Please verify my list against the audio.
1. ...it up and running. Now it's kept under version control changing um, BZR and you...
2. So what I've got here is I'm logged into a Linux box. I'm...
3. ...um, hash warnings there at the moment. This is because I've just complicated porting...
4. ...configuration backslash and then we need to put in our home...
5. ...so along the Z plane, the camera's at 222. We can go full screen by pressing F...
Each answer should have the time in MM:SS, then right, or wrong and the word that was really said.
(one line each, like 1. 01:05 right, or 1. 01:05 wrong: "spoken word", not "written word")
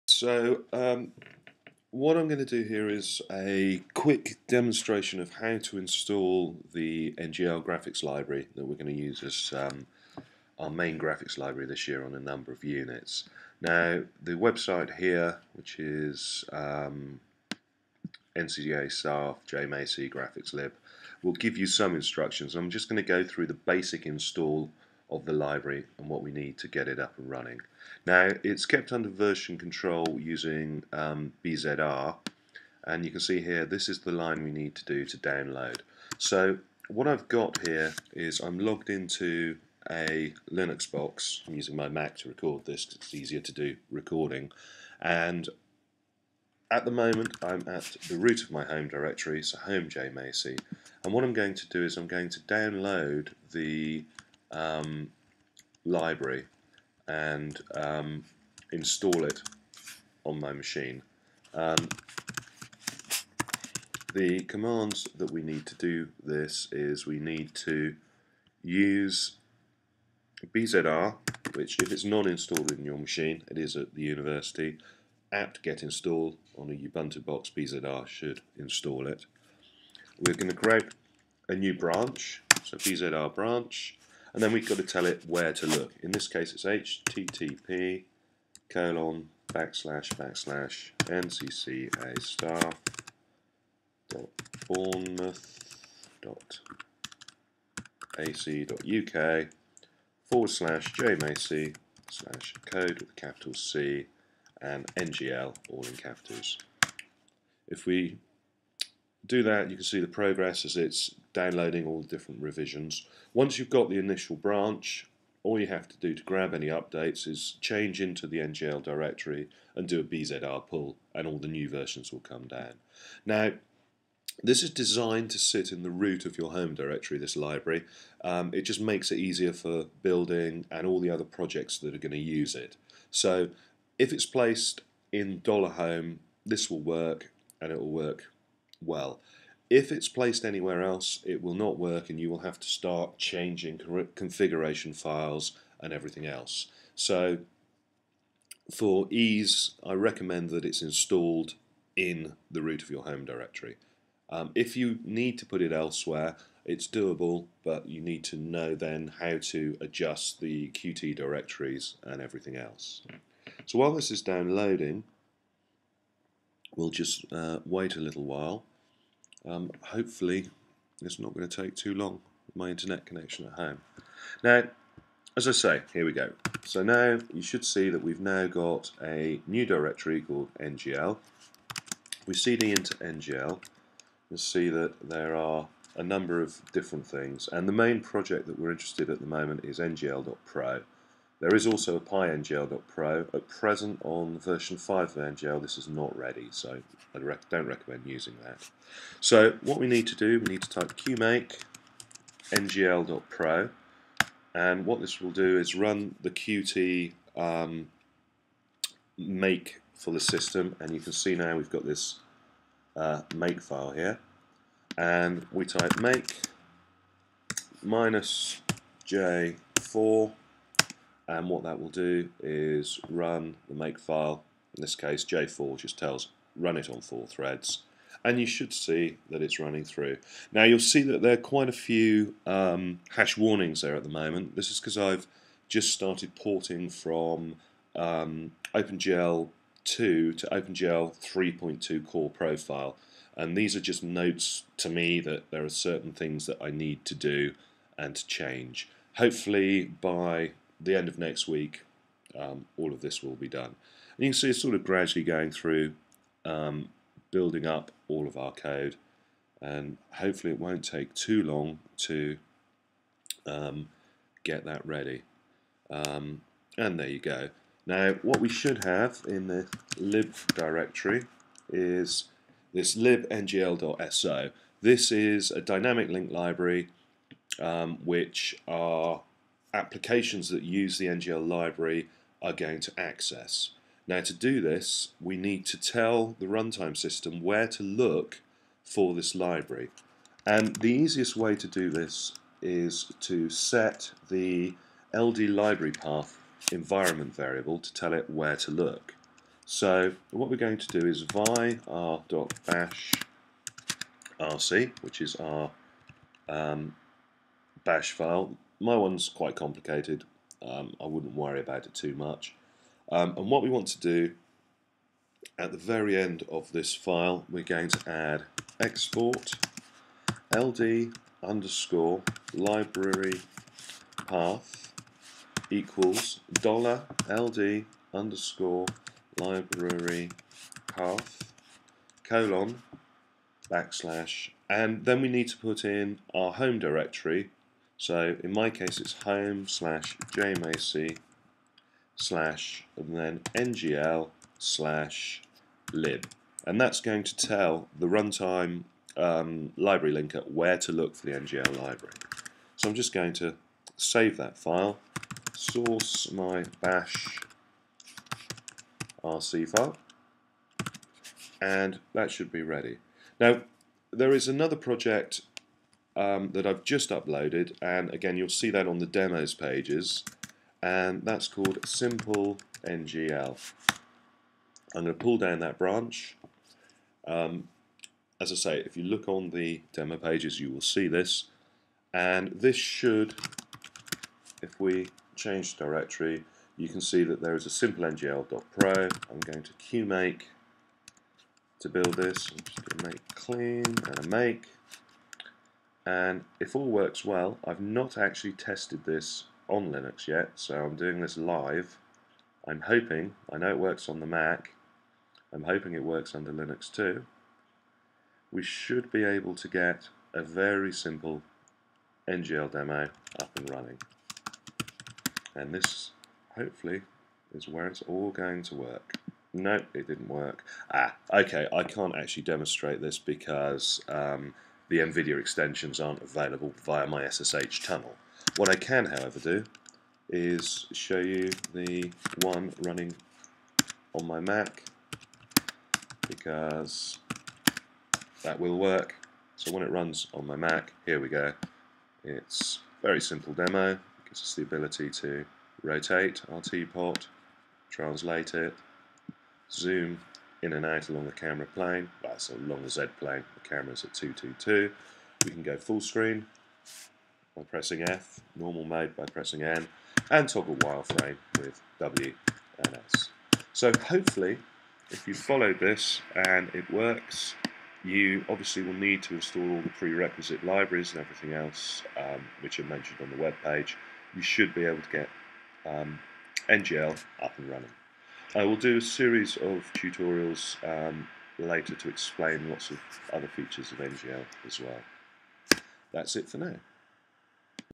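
1. 00:26 wrong: "using", not "changing"
2. 00:36 right
3. 03:52 wrong: "started", not "complicated"
4. 05:32 wrong: "colon", not "configuration"
5. 07:32 right.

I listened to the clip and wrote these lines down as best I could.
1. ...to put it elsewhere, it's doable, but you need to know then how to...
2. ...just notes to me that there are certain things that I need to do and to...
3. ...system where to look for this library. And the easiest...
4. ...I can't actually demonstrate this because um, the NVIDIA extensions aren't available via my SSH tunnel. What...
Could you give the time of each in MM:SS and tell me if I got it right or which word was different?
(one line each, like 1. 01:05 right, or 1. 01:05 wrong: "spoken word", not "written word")
1. 02:35 right
2. 04:03 right
3. 04:46 right
4. 07:01 right.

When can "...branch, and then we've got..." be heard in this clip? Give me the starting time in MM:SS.
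01:23.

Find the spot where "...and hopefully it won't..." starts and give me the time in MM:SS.
04:19.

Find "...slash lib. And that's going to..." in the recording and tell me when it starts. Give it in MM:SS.
05:44.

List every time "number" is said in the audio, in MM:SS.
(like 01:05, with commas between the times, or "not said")
00:12, 03:06.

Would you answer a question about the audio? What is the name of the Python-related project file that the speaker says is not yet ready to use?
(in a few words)
PyNGL.pro.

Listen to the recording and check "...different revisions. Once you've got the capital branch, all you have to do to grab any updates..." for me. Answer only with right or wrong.
wrong.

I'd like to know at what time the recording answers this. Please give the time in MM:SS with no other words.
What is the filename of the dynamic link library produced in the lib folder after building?
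04:32.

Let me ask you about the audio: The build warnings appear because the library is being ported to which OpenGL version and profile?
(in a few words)
OpenGL 3.2 core profile.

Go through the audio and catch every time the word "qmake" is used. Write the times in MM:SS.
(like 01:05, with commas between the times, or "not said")
03:20, 06:29.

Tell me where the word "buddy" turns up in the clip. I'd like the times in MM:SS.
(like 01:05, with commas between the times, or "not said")
not said.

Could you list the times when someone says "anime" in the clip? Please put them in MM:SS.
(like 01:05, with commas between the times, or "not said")
not said.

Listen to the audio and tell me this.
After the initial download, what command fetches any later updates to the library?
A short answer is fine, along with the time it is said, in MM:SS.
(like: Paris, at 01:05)
bzr pull, at 02:00.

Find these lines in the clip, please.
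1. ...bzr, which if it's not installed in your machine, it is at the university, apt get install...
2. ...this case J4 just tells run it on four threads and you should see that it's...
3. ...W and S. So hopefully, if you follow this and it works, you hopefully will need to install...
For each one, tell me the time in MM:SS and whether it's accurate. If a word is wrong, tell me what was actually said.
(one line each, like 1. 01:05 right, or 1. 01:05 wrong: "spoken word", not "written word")
1. 01:10 right
2. 03:44 right
3. 07:41 wrong: "obviously", not "hopefully".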